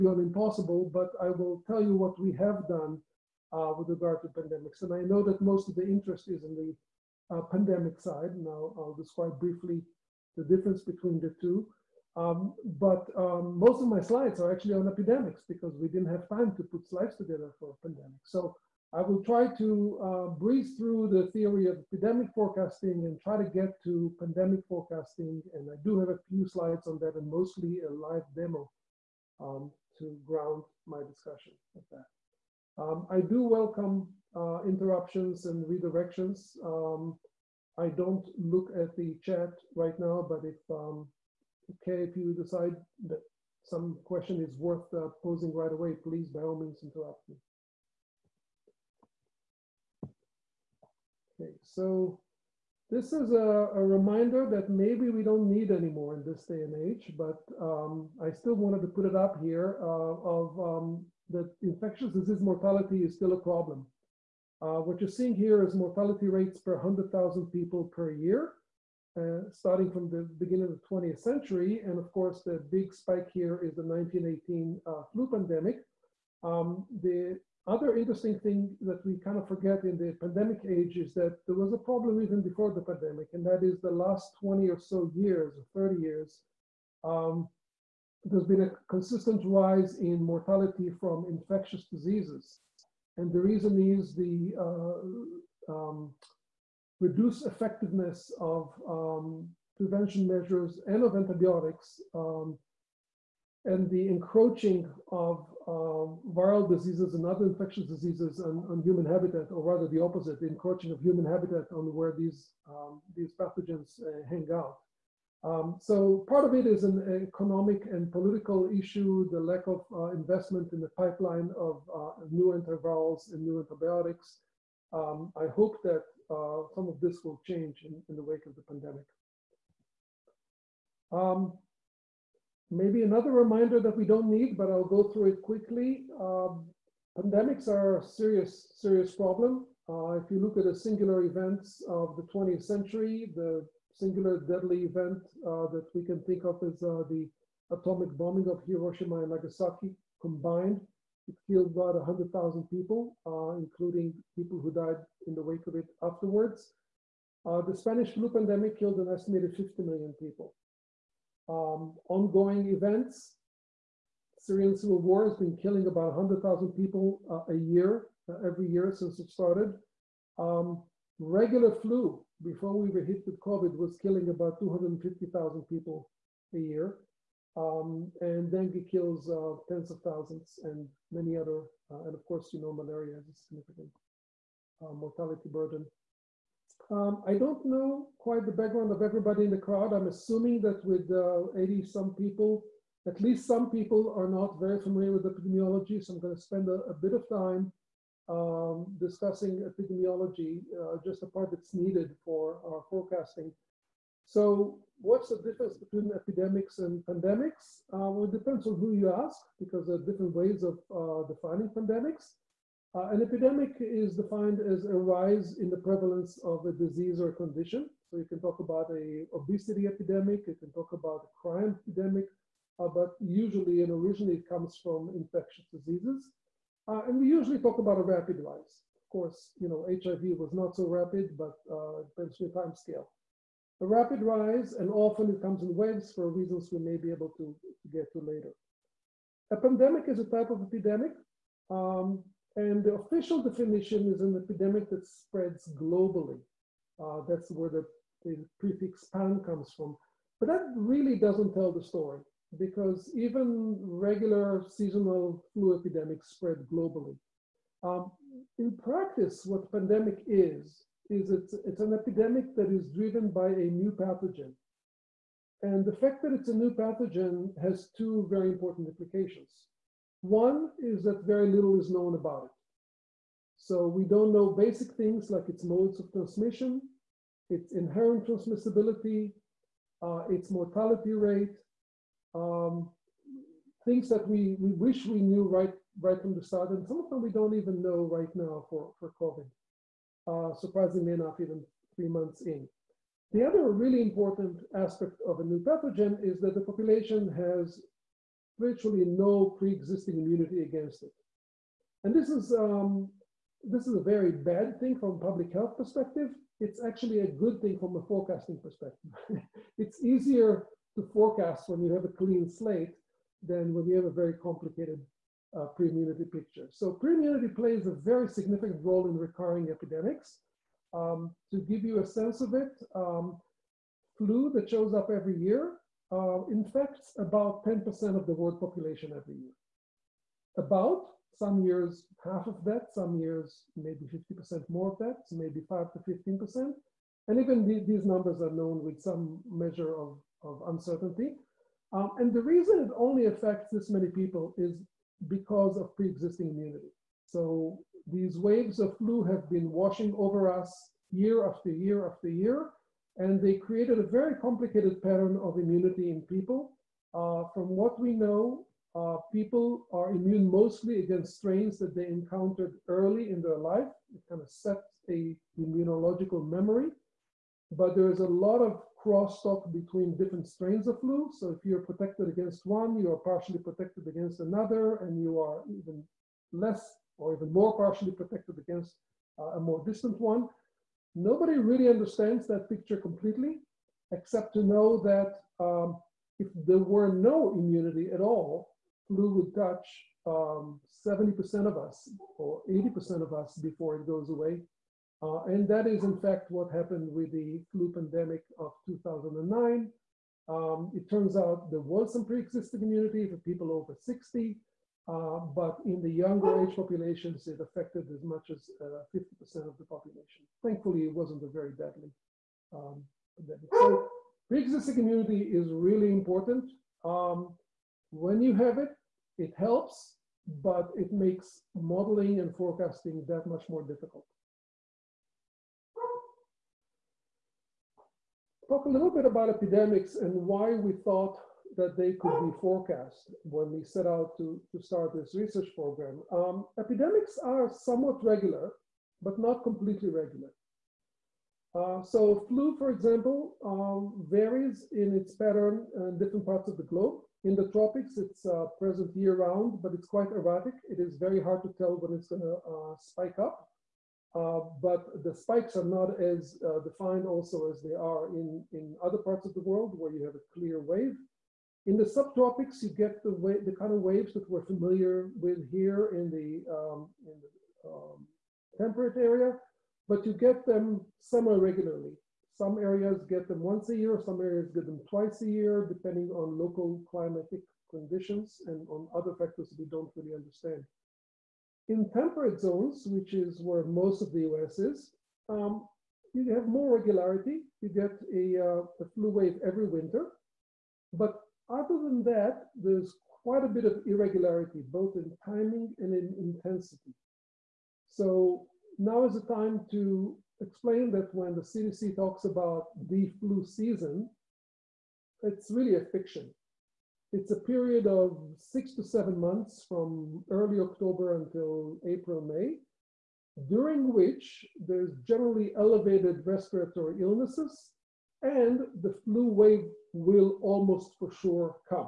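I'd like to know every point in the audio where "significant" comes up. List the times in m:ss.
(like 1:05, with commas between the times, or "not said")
3:03, 5:18.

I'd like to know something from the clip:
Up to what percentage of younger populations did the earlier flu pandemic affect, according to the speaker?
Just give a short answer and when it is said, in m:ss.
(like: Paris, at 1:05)
50%, at 6:48.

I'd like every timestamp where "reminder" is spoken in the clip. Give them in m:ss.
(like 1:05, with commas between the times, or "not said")
0:53, 2:13.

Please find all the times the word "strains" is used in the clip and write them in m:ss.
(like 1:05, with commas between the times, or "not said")
6:01, 6:10.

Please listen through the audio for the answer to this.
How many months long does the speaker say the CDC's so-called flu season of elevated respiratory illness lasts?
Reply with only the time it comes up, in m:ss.
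8:28.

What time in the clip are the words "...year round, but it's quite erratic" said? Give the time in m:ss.
7:29.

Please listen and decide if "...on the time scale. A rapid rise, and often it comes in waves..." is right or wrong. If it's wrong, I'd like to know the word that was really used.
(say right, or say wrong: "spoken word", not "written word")
right.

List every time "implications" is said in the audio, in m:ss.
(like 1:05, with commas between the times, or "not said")
4:28.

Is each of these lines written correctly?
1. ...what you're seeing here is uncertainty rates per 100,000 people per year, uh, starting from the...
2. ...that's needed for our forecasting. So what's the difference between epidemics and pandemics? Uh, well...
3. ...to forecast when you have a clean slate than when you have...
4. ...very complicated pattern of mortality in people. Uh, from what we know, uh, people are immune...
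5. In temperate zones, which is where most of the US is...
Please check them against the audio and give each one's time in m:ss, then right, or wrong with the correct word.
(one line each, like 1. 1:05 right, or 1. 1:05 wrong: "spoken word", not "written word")
1. 1:04 wrong: "mortality", not "uncertainty"
2. 3:21 right
3. 5:10 right
4. 5:54 wrong: "immunity", not "mortality"
5. 8:01 right.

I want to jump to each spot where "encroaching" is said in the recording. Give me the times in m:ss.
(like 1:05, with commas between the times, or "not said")
1:44, 1:50.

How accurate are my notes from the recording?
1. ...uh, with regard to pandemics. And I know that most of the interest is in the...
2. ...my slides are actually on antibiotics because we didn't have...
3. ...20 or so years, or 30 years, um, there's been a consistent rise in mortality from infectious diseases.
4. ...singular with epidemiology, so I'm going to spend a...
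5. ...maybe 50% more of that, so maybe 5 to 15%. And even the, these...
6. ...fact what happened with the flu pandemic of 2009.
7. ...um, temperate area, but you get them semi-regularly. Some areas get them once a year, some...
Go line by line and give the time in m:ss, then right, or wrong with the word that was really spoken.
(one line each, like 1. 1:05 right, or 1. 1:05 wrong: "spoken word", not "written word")
1. 0:03 right
2. 0:13 wrong: "epidemics", not "antibiotics"
3. 1:24 right
4. 3:14 wrong: "familiar", not "singular"
5. 5:33 right
6. 6:36 right
7. 7:47 right.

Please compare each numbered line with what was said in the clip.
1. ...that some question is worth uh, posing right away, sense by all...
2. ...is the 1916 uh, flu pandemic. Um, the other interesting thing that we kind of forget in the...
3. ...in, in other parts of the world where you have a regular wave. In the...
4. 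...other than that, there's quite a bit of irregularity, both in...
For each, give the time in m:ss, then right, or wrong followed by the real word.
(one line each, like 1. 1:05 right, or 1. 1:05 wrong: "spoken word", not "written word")
1. 0:43 wrong: "please", not "sense"
2. 1:13 wrong: "1918", not "1916"
3. 7:38 wrong: "clear", not "regular"
4. 8:11 right.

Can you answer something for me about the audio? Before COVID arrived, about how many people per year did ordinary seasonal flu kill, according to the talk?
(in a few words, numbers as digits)
250,000.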